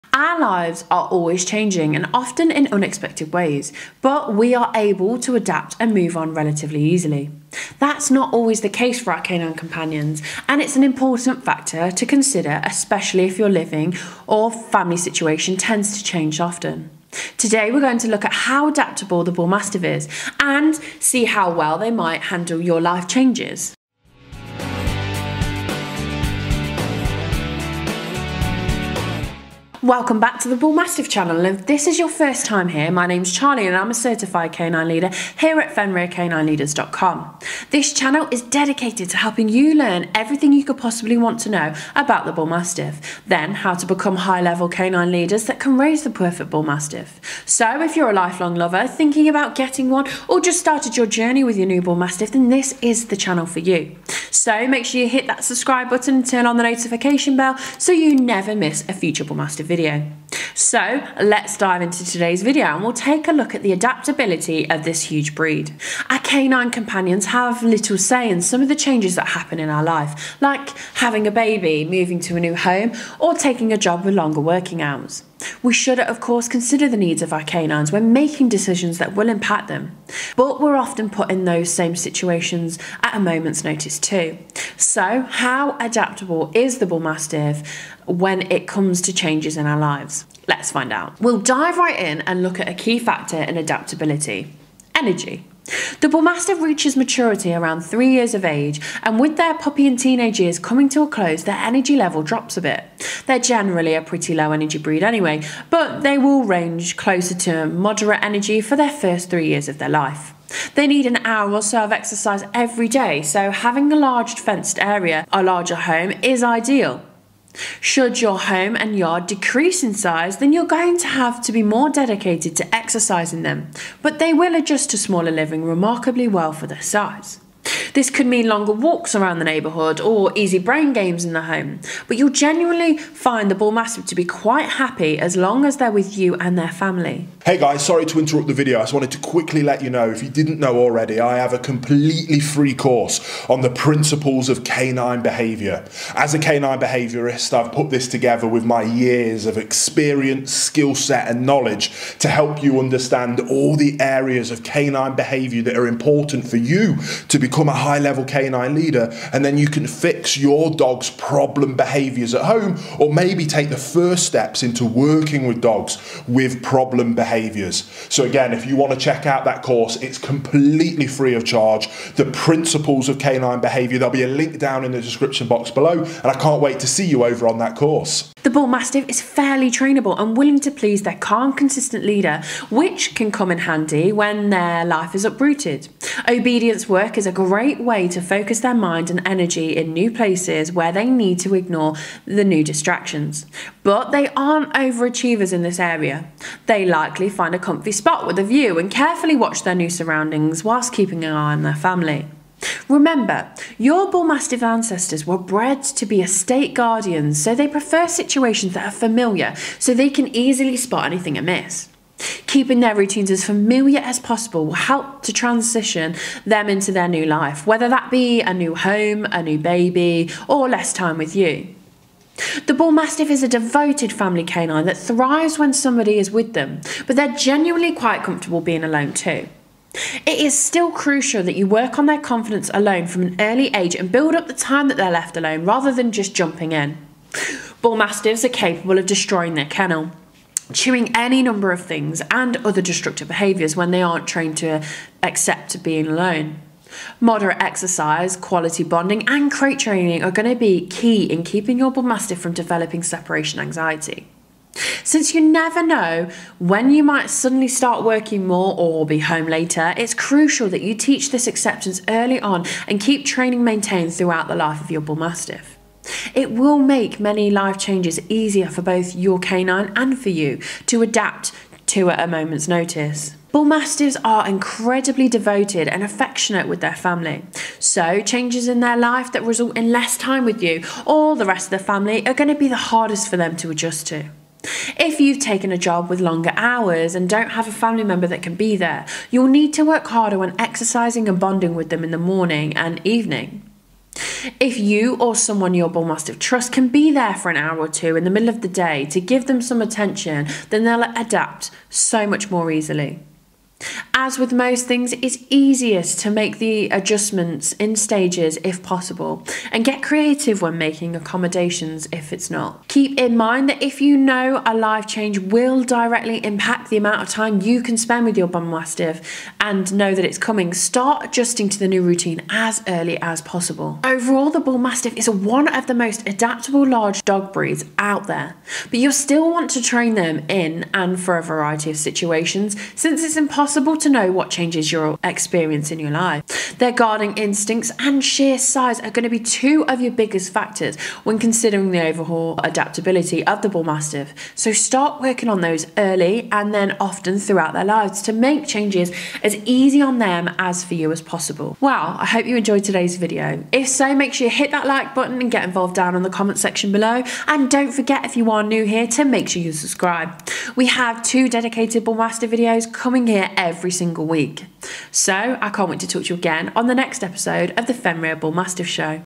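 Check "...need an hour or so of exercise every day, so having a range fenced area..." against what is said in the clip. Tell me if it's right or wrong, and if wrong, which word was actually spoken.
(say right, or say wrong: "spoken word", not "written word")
wrong: "large", not "range".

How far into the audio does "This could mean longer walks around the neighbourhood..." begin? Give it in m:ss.
2:07.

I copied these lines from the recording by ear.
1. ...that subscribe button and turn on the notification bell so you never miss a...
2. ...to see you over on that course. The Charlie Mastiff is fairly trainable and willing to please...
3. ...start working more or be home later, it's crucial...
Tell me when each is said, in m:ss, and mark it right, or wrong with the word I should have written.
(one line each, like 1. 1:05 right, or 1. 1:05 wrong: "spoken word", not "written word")
1. 0:55 right
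2. 2:56 wrong: "Bull", not "Charlie"
3. 4:17 right.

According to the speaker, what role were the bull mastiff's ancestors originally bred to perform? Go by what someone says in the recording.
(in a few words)
estate guardians.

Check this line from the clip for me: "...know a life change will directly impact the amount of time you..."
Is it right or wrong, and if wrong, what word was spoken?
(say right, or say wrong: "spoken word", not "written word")
right.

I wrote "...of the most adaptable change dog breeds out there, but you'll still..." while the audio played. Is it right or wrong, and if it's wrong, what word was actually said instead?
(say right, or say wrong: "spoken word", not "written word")
wrong: "large", not "change".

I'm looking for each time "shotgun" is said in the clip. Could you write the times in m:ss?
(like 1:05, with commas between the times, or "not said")
not said.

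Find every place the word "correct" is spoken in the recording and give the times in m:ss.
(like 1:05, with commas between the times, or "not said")
not said.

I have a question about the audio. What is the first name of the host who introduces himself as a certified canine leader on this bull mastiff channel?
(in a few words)
Charlie.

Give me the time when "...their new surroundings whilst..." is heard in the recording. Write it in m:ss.
3:19.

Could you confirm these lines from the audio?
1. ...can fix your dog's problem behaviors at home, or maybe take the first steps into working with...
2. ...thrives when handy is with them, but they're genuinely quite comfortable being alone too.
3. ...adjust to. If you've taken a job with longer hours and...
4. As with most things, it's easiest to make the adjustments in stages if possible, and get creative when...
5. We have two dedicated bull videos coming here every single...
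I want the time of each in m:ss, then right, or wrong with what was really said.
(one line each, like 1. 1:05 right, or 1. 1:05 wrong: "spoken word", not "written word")
1. 2:39 right
2. 3:44 wrong: "somebody", not "handy"
3. 4:43 right
4. 5:04 right
5. 6:00 right.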